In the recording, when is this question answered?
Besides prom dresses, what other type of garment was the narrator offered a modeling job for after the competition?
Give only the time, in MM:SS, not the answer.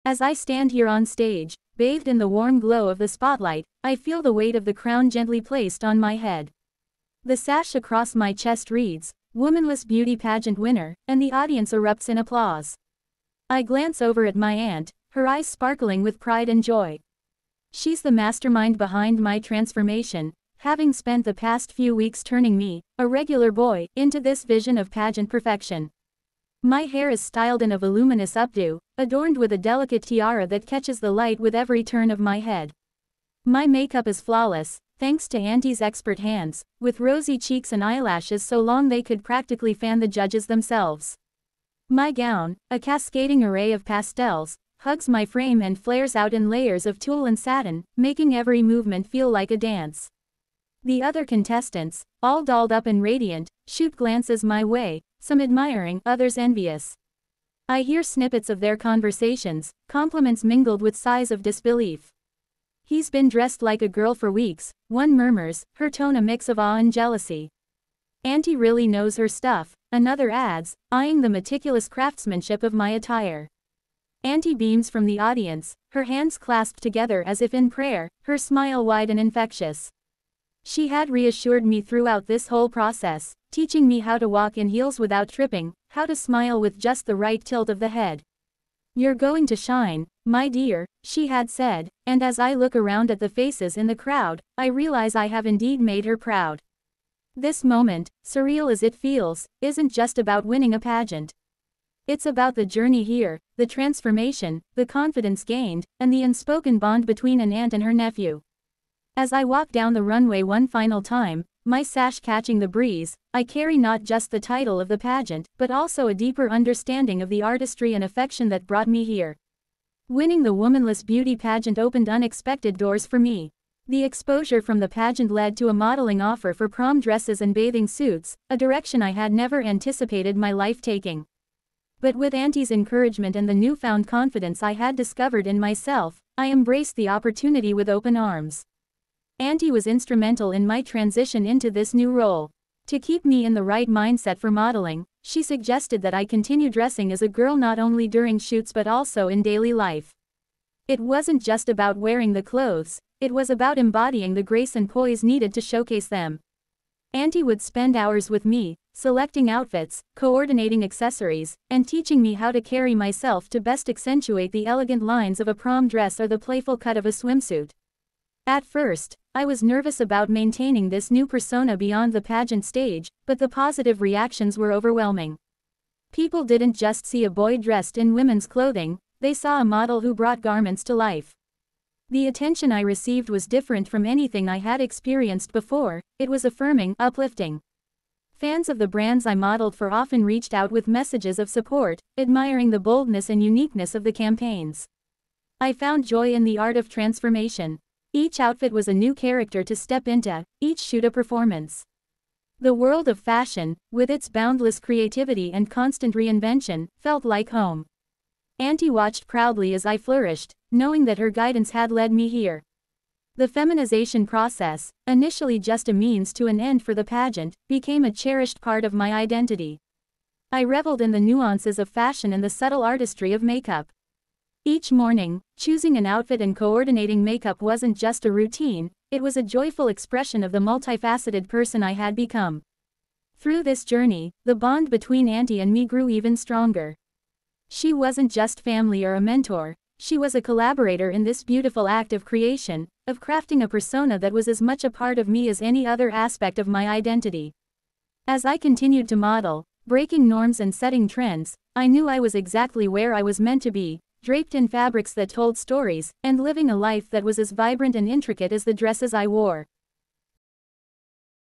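02:07.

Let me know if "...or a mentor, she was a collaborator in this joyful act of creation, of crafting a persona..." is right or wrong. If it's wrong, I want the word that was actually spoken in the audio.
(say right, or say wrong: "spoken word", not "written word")
wrong: "beautiful", not "joyful".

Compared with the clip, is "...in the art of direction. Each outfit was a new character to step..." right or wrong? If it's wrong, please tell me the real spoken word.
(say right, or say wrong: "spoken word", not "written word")
wrong: "transformation", not "direction".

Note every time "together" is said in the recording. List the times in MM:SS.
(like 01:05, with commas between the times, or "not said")
01:16.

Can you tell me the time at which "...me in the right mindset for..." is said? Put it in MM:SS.
02:23.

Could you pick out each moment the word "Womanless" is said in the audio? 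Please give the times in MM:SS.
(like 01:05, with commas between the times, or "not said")
00:09, 02:00.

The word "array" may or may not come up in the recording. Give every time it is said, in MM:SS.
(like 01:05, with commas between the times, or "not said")
00:43.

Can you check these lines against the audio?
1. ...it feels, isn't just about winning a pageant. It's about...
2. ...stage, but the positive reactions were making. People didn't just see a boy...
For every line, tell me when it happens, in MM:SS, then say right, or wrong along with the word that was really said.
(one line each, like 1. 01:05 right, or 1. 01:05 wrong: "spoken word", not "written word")
1. 01:38 right
2. 02:52 wrong: "overwhelming", not "making".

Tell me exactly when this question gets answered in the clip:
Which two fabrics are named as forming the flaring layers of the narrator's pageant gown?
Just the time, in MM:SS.
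00:46.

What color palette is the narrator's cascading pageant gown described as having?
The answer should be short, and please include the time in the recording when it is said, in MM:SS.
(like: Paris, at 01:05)
Pastels, at 00:43.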